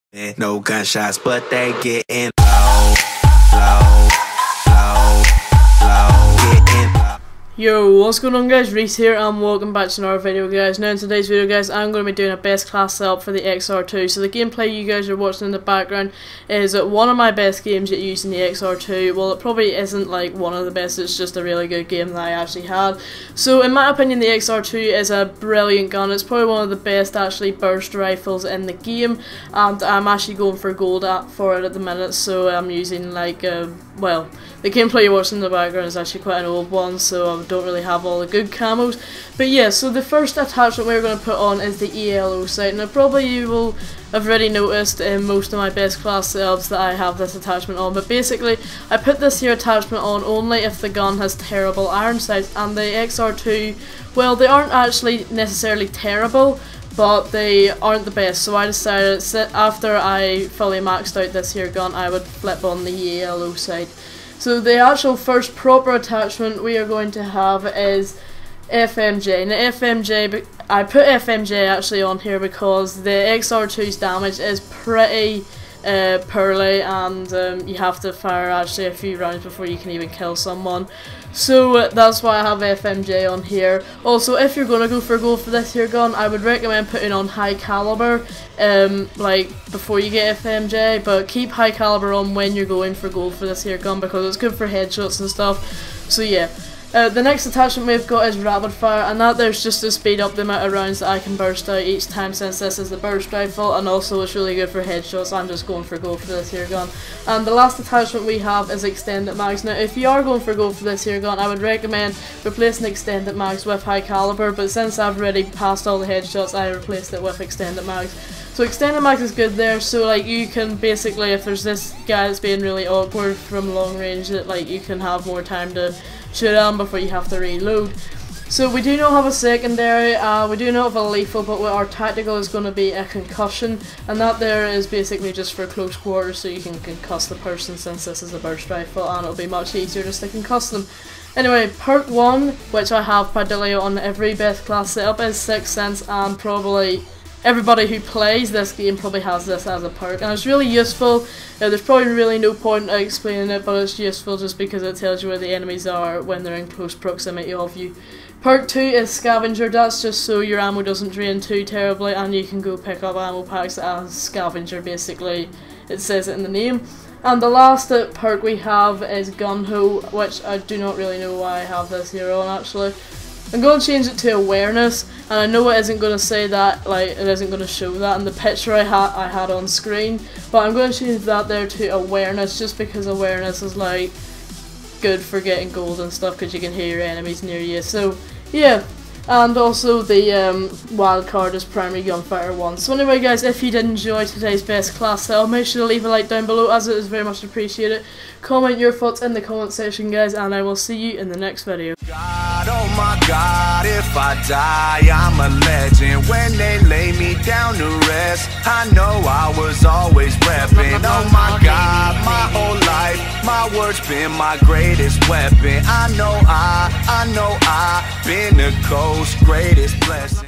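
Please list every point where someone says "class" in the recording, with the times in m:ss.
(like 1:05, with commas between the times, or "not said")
0:12, 0:45, 2:24, 3:14.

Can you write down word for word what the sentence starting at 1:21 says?
So uh, that's why I have FMJ on here.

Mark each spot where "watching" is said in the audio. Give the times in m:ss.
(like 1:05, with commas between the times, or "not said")
0:15, 0:35.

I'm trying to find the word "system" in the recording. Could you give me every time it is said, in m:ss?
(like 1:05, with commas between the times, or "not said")
not said.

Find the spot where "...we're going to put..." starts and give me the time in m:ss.
0:40.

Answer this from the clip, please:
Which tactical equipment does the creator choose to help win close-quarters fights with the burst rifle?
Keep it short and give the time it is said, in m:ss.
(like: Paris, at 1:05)
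Concussion, at 2:13.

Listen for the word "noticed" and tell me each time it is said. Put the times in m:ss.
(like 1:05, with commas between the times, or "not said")
0:44.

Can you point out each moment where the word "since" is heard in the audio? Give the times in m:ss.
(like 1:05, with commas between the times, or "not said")
1:42, 1:54, 2:17.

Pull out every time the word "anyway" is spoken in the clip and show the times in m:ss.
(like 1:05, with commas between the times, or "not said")
2:21, 3:12.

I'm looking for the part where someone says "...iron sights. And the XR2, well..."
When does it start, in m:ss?
0:51.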